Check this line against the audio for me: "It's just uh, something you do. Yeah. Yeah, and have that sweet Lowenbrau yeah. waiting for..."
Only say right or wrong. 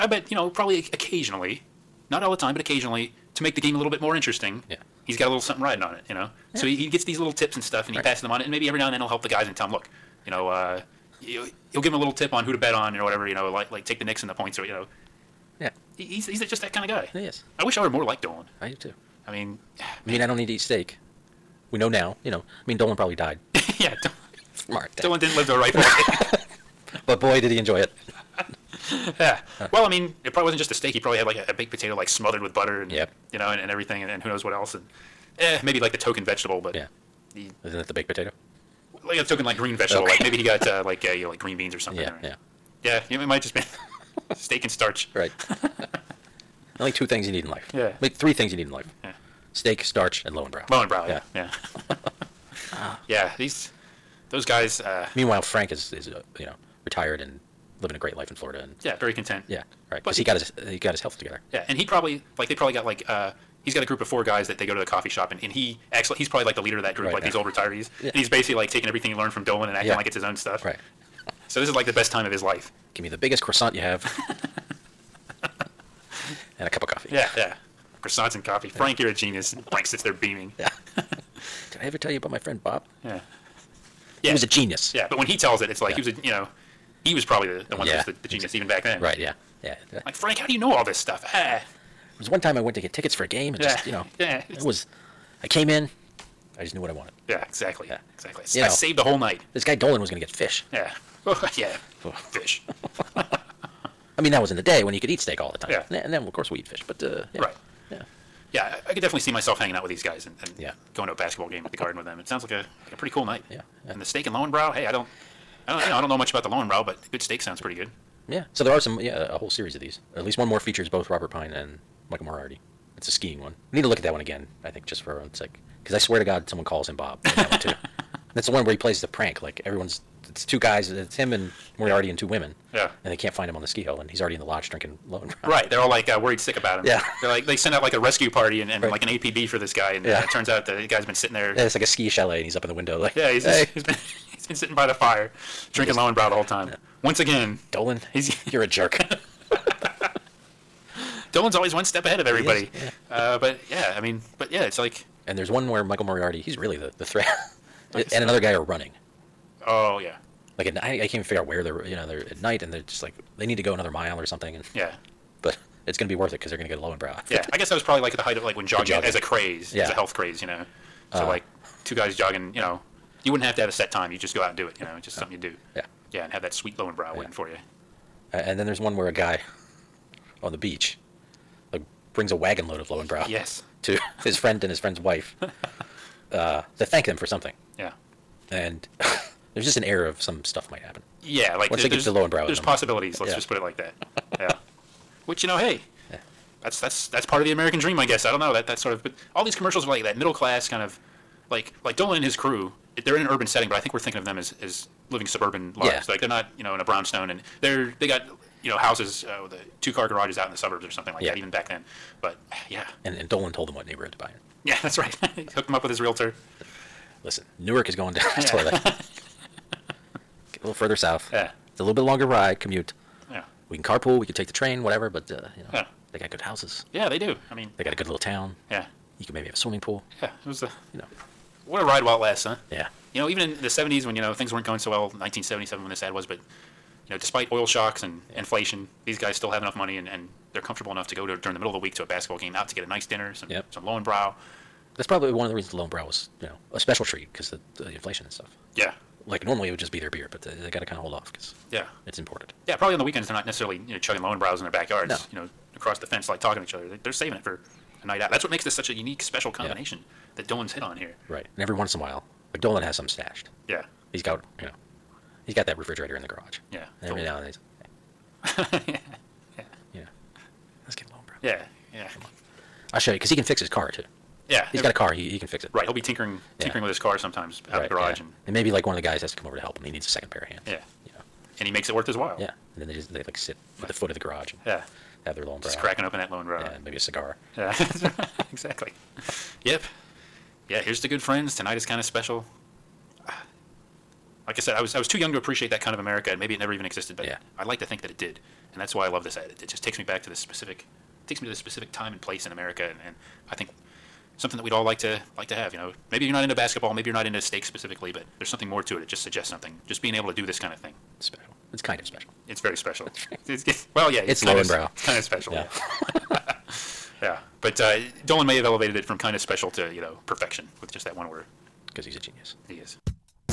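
right.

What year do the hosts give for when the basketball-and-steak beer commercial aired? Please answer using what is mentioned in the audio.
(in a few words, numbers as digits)
1977.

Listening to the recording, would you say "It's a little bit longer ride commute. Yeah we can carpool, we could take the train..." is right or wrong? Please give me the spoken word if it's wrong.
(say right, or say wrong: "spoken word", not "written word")
right.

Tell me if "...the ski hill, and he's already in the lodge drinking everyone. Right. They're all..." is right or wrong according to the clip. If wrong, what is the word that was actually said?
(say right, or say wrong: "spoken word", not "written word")
wrong: "alone", not "everyone".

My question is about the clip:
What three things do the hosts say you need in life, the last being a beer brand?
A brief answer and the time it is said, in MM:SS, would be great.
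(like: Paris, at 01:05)
Steak, starch, and Lowenbrau, at 00:49.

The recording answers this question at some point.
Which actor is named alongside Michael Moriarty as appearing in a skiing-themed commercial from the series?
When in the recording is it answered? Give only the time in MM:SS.
02:01.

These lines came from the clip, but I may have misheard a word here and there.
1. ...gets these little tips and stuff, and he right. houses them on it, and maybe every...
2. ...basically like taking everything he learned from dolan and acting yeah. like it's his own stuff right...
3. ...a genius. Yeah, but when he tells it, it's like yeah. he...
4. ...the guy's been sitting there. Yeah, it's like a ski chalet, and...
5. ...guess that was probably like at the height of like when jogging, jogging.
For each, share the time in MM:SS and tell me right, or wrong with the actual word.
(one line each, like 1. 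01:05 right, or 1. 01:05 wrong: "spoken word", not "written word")
1. 00:06 wrong: "passes", not "houses"
2. 01:08 right
3. 01:24 right
4. 02:20 right
5. 02:47 right.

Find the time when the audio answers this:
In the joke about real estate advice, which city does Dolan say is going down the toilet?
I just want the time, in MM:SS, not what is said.
03:37.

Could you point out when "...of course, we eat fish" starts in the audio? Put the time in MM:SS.
01:46.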